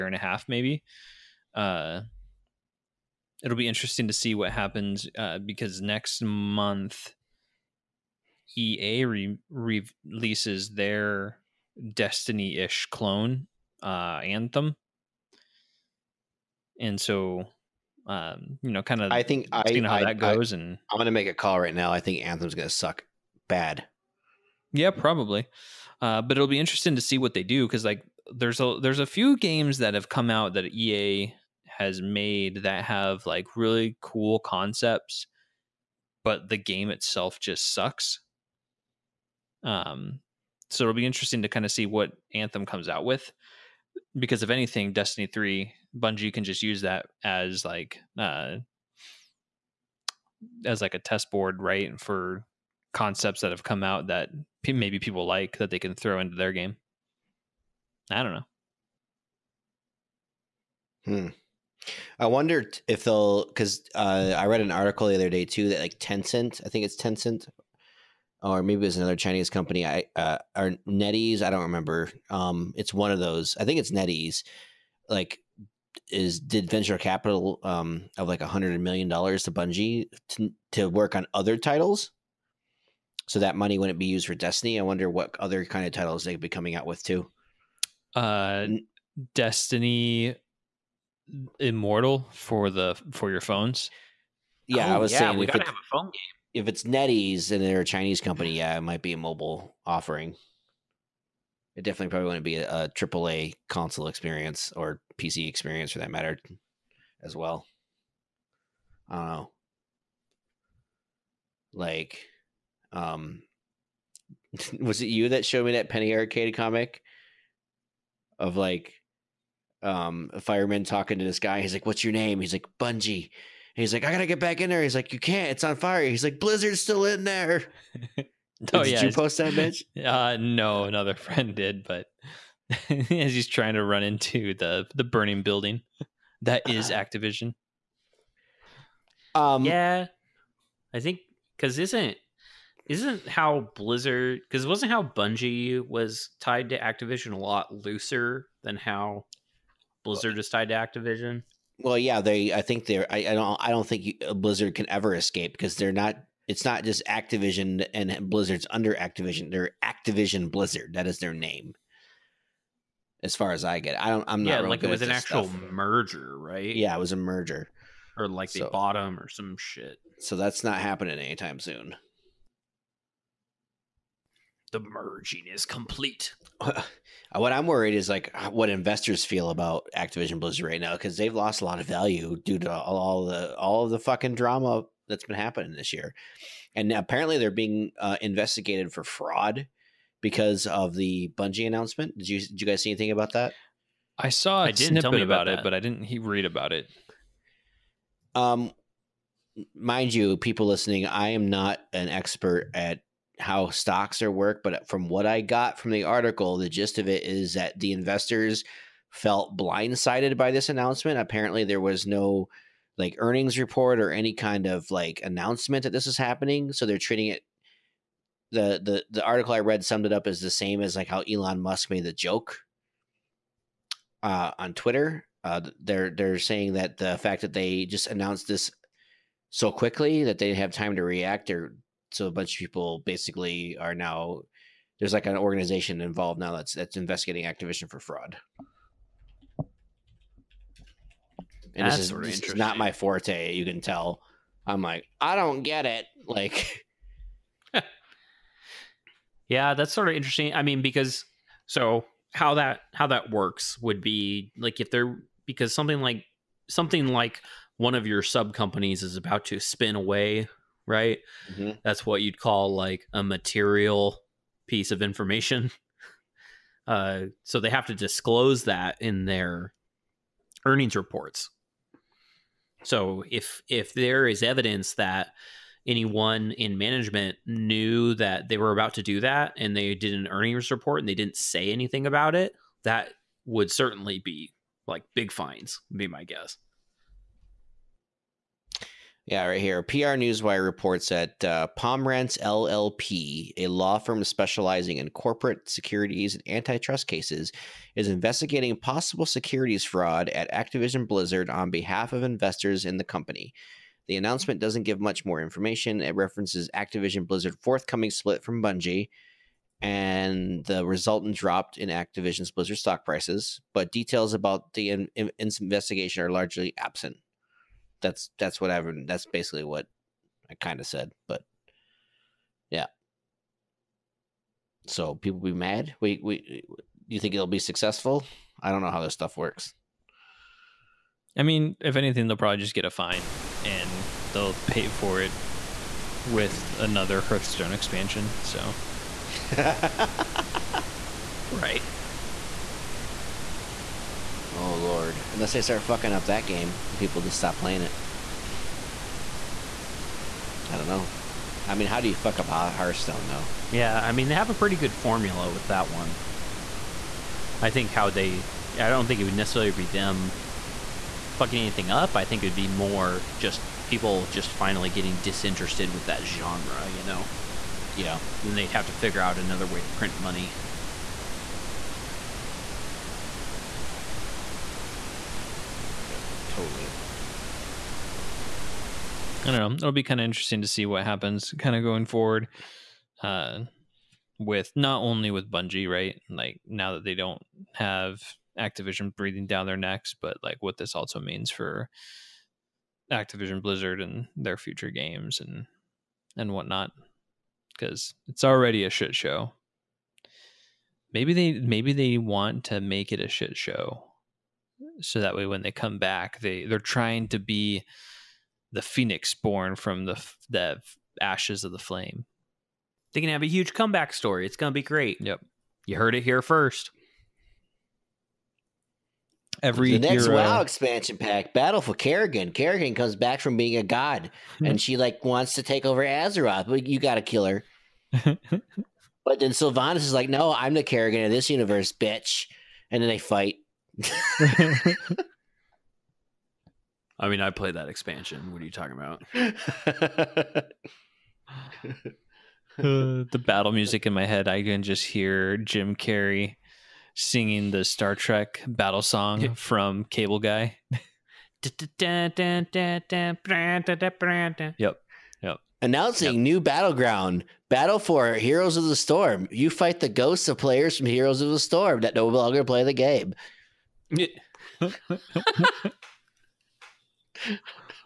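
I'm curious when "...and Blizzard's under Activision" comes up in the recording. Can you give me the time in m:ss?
2:37.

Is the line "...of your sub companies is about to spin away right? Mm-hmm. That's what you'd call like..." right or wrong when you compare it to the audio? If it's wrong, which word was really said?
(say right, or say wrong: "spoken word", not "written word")
right.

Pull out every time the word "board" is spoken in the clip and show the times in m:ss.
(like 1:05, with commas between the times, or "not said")
0:51.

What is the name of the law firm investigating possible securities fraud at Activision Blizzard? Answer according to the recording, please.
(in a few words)
Pomerantz LLP.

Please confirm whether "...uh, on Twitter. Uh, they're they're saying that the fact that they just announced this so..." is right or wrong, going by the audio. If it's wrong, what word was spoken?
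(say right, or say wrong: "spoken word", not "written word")
right.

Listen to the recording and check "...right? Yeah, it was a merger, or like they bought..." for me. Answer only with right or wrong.
right.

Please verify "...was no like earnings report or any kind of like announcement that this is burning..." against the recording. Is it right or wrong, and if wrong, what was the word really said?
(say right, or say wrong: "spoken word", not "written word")
wrong: "happening", not "burning".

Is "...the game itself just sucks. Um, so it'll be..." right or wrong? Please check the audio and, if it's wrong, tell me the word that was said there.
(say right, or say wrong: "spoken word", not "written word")
right.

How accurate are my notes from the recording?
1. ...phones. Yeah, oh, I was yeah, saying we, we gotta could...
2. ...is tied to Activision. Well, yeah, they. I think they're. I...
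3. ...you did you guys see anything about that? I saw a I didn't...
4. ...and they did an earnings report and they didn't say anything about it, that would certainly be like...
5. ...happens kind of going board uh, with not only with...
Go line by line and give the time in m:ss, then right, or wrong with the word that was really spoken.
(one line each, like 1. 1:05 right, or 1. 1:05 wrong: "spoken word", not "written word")
1. 1:33 right
2. 2:30 right
3. 3:12 right
4. 4:39 right
5. 6:21 wrong: "forward", not "board".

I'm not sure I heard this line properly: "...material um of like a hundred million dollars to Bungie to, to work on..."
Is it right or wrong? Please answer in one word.
wrong.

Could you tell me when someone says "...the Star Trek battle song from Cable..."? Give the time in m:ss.
7:27.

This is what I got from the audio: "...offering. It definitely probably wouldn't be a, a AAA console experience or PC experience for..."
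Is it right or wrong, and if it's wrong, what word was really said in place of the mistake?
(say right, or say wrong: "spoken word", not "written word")
right.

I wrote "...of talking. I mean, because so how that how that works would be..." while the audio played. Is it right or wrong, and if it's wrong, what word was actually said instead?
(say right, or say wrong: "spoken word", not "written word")
wrong: "interesting", not "talking".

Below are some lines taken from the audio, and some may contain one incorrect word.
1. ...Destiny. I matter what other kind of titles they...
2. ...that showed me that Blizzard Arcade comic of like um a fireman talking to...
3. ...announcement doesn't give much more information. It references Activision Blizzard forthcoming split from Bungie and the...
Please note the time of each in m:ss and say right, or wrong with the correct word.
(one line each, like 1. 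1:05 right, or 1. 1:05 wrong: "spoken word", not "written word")
1. 1:24 wrong: "wonder", not "matter"
2. 1:55 wrong: "Penny", not "Blizzard"
3. 5:04 right.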